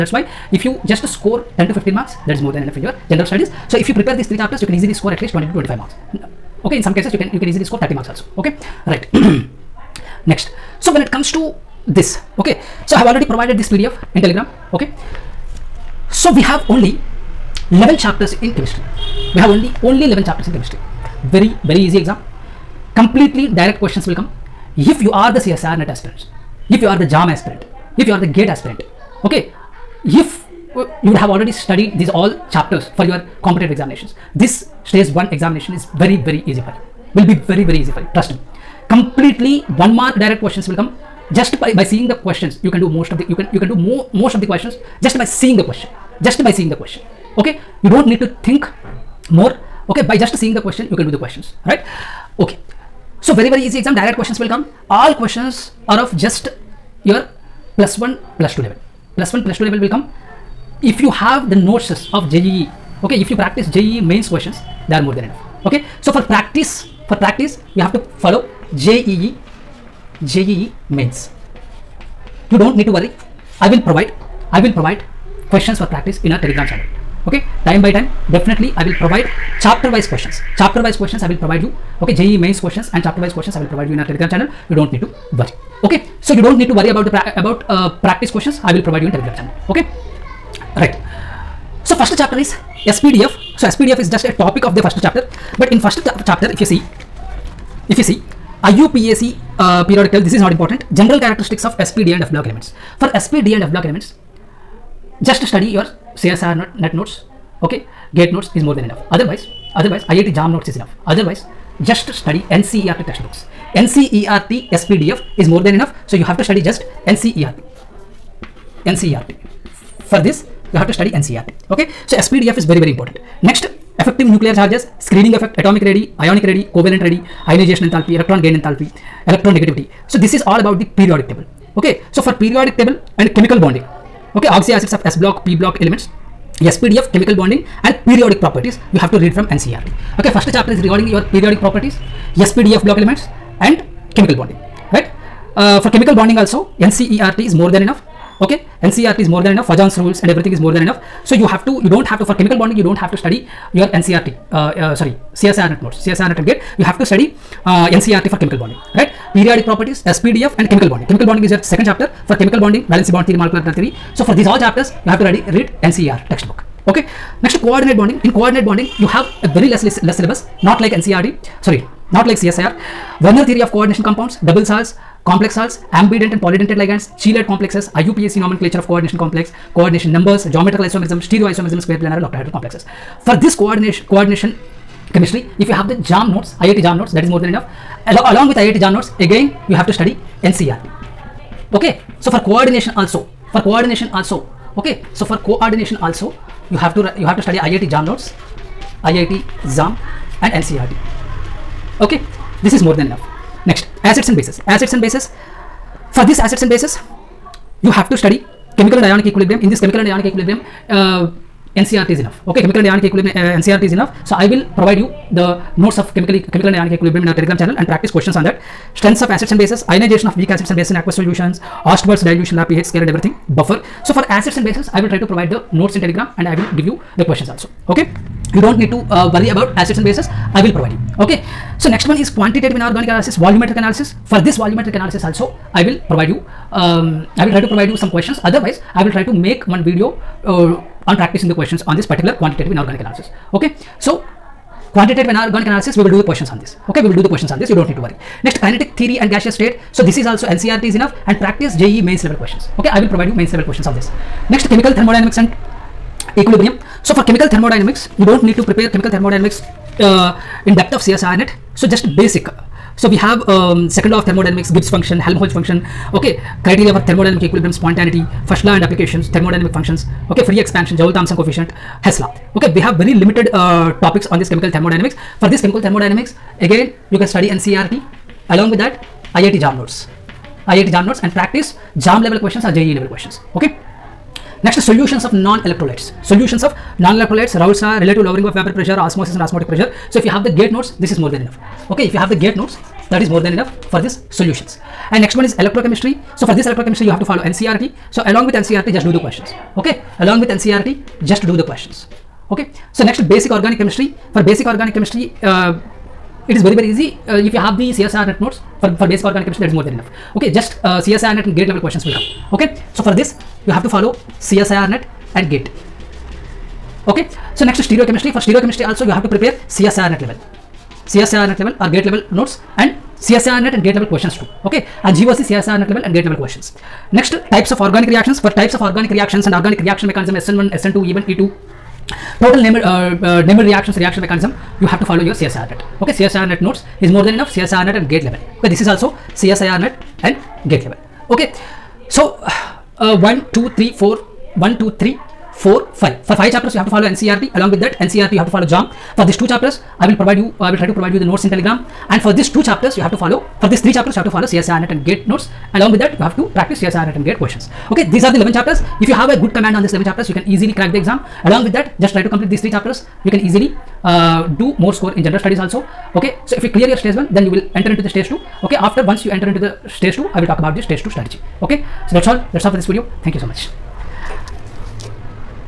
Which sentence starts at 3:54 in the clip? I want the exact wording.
For this volumetric analysis also, I will provide you, um, I will try to provide you some questions.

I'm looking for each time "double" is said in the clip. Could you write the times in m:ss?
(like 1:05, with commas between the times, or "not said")
2:54.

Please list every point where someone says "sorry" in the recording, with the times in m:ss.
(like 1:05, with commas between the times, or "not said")
2:34, 2:51.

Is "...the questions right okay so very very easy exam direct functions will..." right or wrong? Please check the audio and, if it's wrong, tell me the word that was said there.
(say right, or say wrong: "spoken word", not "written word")
wrong: "questions", not "functions".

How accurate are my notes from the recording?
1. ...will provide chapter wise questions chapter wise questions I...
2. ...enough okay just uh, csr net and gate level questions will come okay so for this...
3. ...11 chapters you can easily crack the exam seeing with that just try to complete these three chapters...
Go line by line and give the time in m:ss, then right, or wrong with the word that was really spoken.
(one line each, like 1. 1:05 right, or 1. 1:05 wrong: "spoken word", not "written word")
1. 1:18 right
2. 5:09 right
3. 5:59 wrong: "along", not "seeing".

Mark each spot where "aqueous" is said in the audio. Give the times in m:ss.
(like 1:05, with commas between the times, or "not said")
3:40.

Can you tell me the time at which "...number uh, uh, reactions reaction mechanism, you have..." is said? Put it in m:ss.
5:32.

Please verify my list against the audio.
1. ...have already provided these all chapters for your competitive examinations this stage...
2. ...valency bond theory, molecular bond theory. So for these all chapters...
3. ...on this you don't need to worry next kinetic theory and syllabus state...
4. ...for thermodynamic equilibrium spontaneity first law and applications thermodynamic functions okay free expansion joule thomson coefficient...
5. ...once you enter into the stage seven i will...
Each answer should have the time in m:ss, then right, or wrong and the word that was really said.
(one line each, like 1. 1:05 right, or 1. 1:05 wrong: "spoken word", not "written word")
1. 0:31 wrong: "studied", not "provided"
2. 2:42 right
3. 4:07 wrong: "gaseous", not "syllabus"
4. 4:26 right
5. 6:09 wrong: "two", not "seven".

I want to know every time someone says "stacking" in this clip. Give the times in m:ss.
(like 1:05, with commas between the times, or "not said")
not said.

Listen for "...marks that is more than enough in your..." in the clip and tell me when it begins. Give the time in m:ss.
0:01.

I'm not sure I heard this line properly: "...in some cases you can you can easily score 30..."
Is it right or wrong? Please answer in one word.
right.